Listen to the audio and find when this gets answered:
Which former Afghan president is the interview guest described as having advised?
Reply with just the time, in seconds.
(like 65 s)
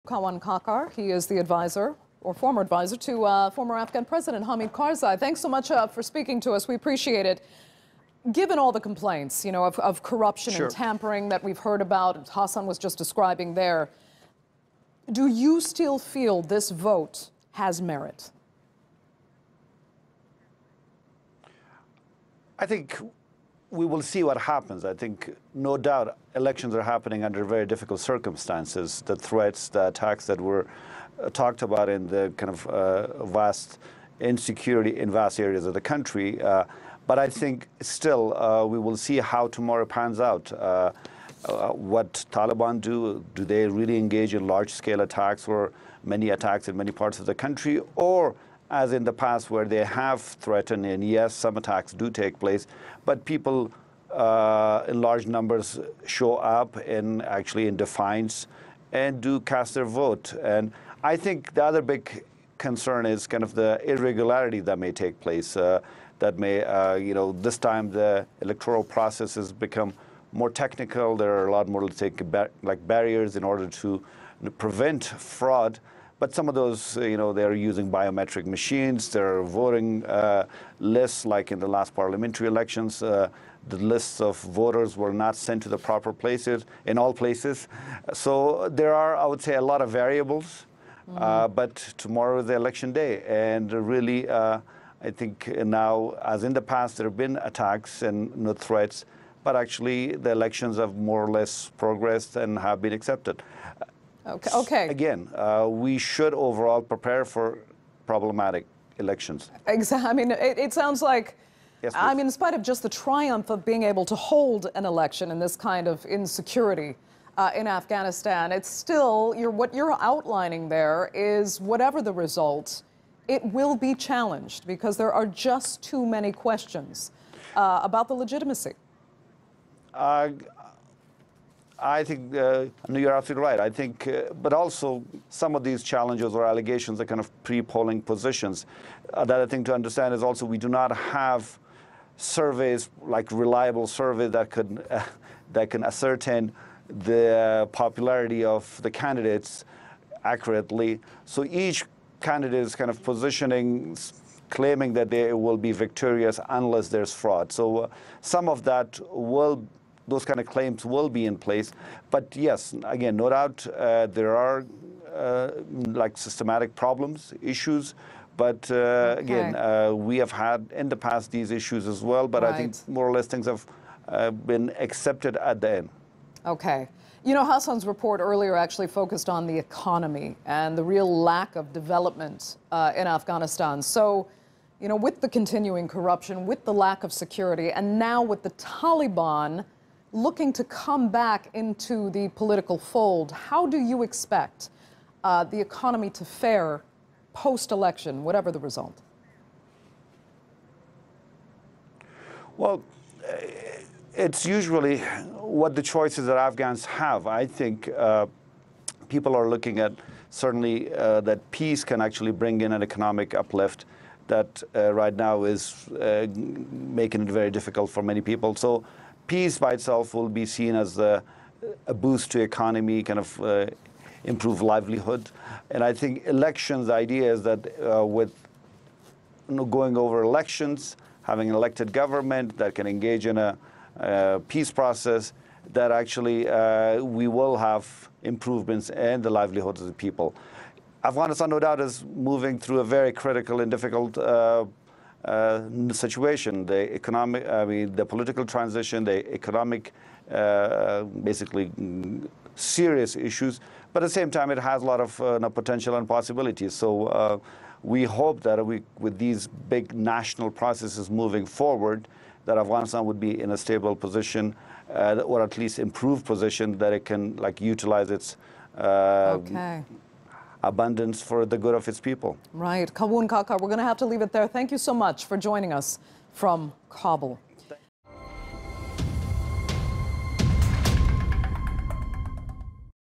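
4 s.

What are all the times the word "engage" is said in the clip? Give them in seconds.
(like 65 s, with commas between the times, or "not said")
43 s, 232 s.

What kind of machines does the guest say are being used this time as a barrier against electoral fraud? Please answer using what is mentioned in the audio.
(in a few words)
Biometric machines.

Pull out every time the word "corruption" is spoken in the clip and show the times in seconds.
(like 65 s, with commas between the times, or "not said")
10 s, 185 s.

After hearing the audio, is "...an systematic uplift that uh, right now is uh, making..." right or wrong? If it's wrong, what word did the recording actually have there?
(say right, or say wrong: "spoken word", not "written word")
wrong: "economic", not "systematic".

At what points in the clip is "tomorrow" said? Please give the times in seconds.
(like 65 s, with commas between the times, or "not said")
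39 s, 92 s.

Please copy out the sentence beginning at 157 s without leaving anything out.
So uh, some of that will those kind of claims will be in place.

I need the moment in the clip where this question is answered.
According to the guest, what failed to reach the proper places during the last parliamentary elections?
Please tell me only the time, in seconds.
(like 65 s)
83 s.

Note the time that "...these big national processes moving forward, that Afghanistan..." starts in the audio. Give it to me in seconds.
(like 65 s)
259 s.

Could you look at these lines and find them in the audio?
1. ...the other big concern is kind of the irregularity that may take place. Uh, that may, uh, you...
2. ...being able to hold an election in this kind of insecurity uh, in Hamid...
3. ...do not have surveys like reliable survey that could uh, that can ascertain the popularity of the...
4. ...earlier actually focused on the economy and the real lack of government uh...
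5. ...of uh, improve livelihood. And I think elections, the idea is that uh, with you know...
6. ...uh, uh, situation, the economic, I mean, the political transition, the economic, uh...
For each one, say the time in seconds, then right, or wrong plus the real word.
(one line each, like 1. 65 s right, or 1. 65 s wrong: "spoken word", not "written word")
1. 61 s right
2. 113 s wrong: "Afghanistan", not "Hamid"
3. 140 s right
4. 178 s wrong: "development", not "government"
5. 223 s right
6. 244 s right.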